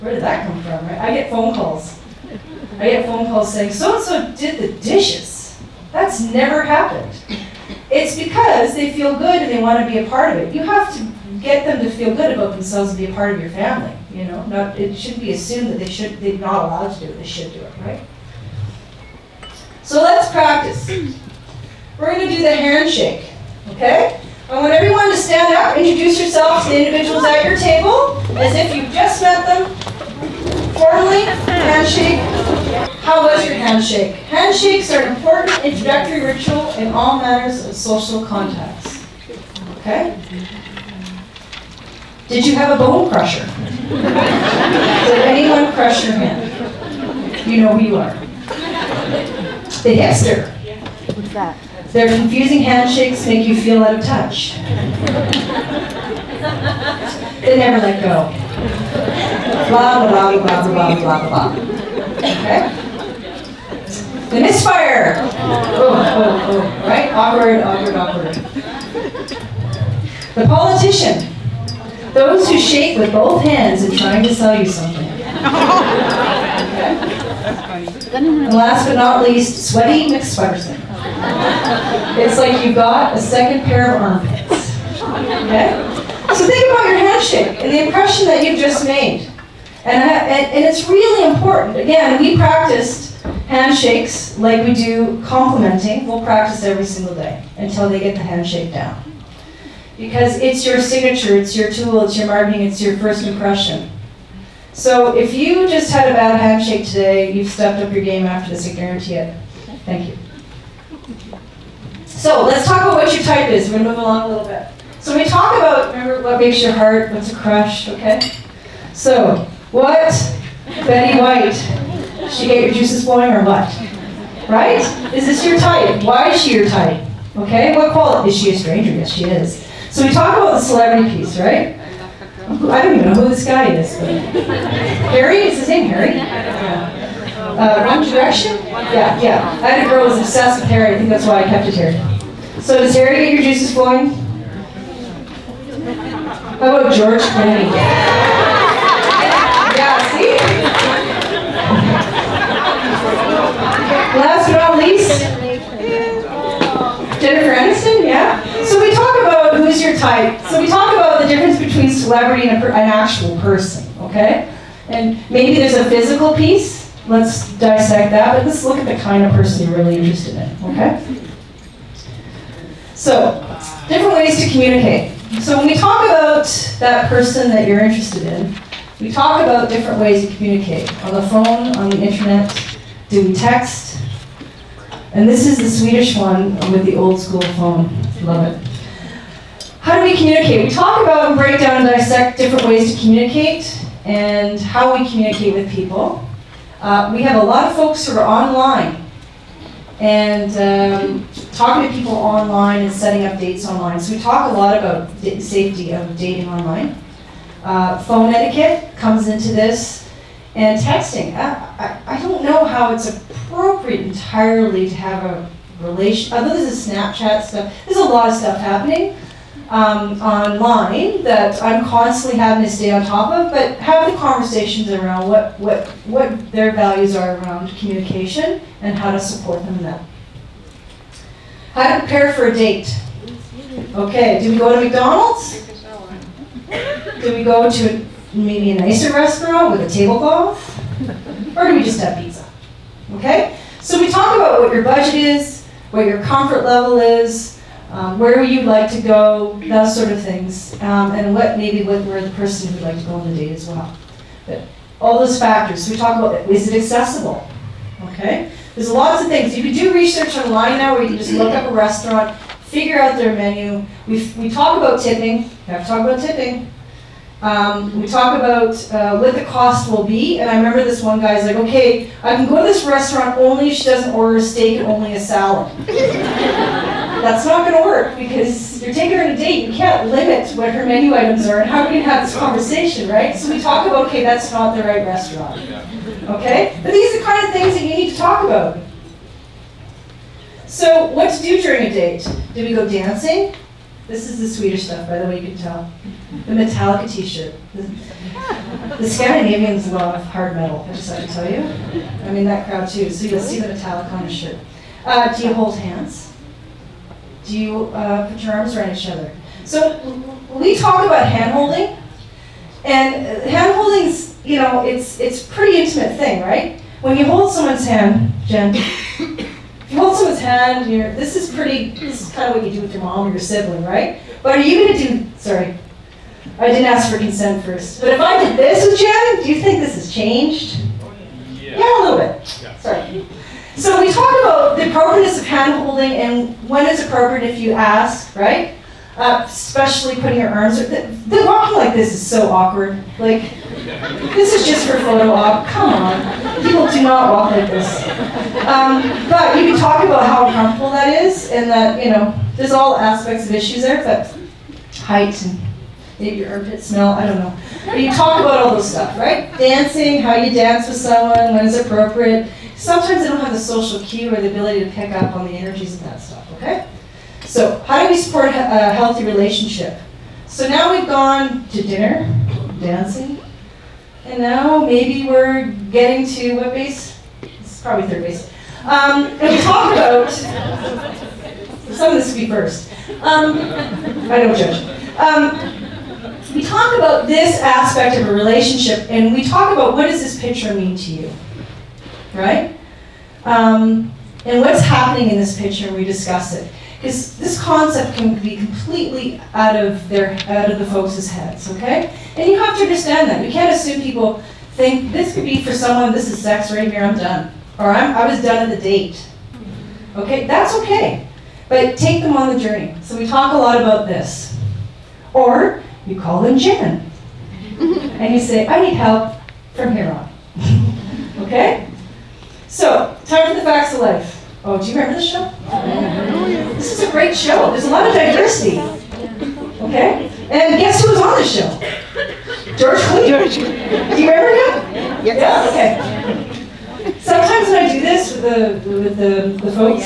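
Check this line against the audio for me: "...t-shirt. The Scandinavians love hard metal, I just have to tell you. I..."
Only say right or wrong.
right.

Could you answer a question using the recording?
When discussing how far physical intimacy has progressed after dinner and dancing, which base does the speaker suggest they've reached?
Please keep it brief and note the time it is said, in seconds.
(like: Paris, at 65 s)
third base, at 378 s.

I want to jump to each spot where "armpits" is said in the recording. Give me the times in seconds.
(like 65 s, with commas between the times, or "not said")
84 s, 356 s.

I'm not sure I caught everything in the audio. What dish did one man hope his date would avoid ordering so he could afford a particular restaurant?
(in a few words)
steak.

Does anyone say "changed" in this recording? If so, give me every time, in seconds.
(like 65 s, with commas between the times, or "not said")
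330 s.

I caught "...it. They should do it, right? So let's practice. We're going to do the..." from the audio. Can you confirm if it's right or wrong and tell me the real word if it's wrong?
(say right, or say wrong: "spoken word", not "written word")
right.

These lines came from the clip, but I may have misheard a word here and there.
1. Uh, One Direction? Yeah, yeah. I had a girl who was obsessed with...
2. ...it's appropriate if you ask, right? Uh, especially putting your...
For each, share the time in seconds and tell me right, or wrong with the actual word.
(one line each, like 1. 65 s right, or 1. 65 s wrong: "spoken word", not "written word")
1. 137 s right
2. 336 s right.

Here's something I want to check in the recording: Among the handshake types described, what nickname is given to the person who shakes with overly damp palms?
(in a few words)
Sweaty McSweaterson.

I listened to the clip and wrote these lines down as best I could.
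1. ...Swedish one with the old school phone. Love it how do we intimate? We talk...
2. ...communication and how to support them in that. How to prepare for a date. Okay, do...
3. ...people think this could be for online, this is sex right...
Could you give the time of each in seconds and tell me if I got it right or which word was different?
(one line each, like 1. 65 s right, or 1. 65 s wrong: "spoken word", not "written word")
1. 185 s wrong: "communicate", not "intimate"
2. 227 s right
3. 404 s wrong: "someone", not "online".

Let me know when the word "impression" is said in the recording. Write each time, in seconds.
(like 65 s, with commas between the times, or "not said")
87 s, 103 s.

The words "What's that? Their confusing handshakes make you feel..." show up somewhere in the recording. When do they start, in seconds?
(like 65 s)
51 s.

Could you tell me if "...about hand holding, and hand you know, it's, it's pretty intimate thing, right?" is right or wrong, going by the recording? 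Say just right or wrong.
right.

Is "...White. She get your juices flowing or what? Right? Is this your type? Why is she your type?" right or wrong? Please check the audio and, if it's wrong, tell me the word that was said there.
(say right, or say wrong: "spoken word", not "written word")
right.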